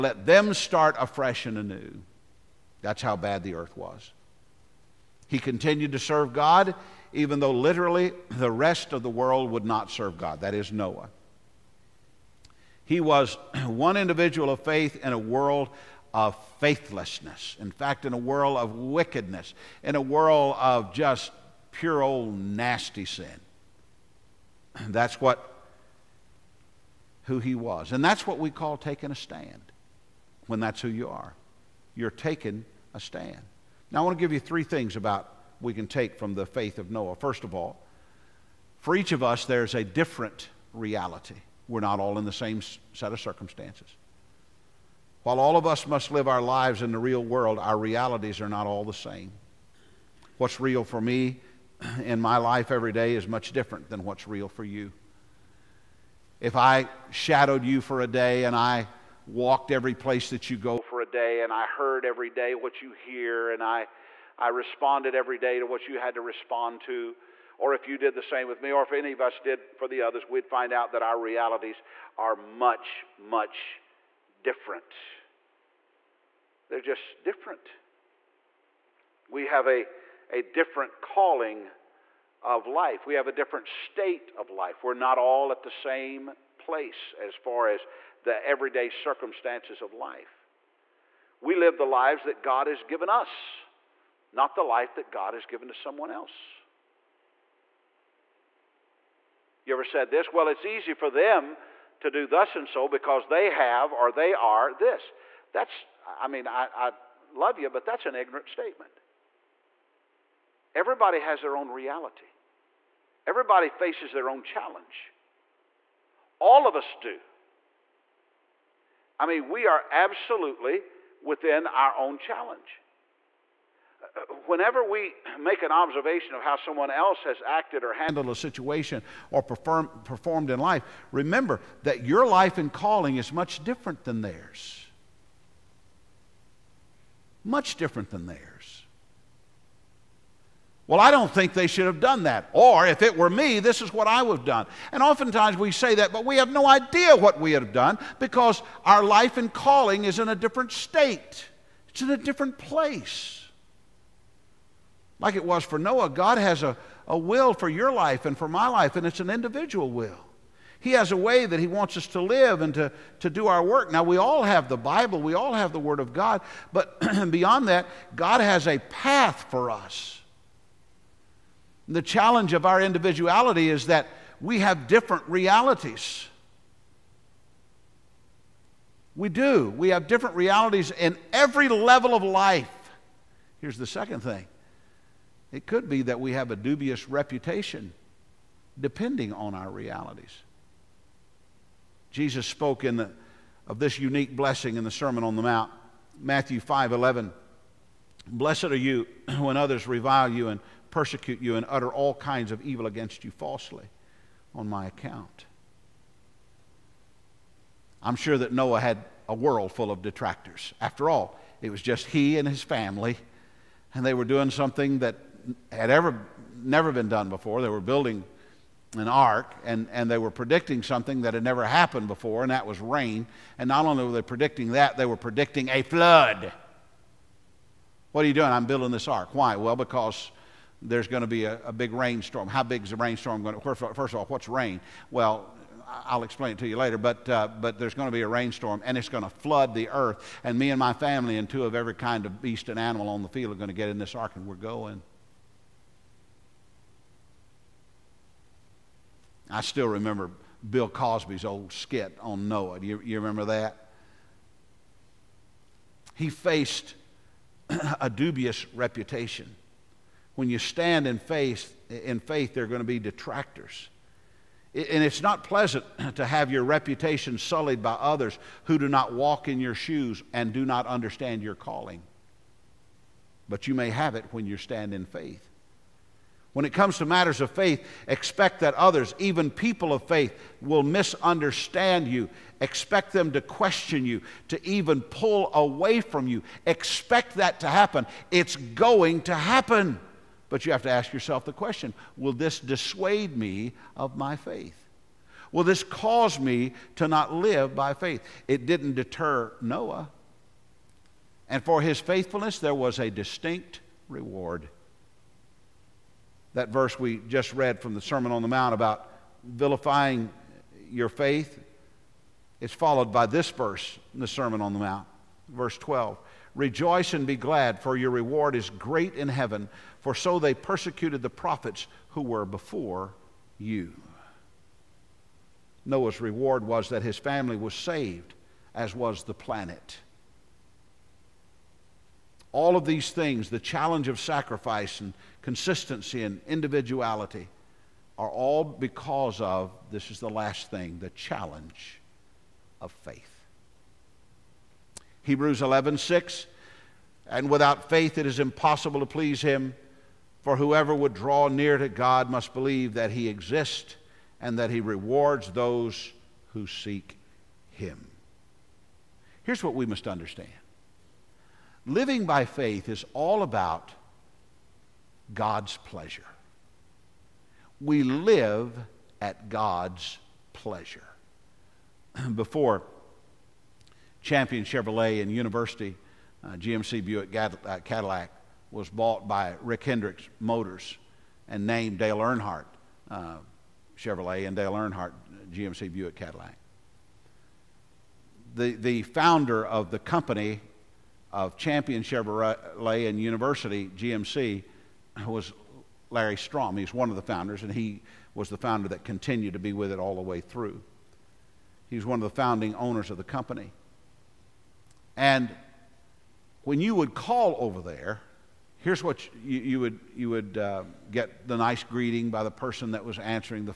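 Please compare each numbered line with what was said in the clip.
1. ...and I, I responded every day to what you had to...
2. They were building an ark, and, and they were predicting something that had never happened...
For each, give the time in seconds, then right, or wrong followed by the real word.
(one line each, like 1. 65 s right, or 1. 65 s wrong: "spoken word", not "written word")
1. 63 s right
2. 217 s right.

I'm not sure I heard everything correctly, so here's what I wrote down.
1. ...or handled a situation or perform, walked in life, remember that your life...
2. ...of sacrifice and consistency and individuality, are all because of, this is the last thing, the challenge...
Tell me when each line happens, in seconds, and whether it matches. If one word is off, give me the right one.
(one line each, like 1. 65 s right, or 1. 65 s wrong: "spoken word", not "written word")
1. 127 s wrong: "performed", not "walked"
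2. 334 s right.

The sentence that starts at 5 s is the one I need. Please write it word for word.
He continued to serve God, even though literally the rest of the world would not serve God.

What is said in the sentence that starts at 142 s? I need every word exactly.
Or if it were me, this is what I would have done.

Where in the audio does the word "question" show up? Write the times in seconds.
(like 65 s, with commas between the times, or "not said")
283 s, 291 s.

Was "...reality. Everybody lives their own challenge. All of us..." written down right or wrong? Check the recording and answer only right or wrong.
wrong.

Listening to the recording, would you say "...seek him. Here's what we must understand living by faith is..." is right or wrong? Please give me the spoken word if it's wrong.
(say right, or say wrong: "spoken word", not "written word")
right.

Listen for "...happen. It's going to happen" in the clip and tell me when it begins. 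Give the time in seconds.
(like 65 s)
287 s.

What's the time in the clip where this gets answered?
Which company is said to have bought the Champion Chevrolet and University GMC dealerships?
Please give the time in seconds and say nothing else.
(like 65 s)
379 s.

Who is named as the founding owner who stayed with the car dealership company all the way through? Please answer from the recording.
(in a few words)
Larry Strom.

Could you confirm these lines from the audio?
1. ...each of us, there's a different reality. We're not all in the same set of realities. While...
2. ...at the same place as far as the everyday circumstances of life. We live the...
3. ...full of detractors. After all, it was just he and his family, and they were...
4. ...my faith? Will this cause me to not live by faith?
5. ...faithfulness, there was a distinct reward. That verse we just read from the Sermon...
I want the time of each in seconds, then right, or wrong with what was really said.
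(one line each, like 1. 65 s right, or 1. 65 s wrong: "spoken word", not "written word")
1. 38 s wrong: "circumstances", not "realities"
2. 85 s right
3. 209 s right
4. 294 s right
5. 301 s right.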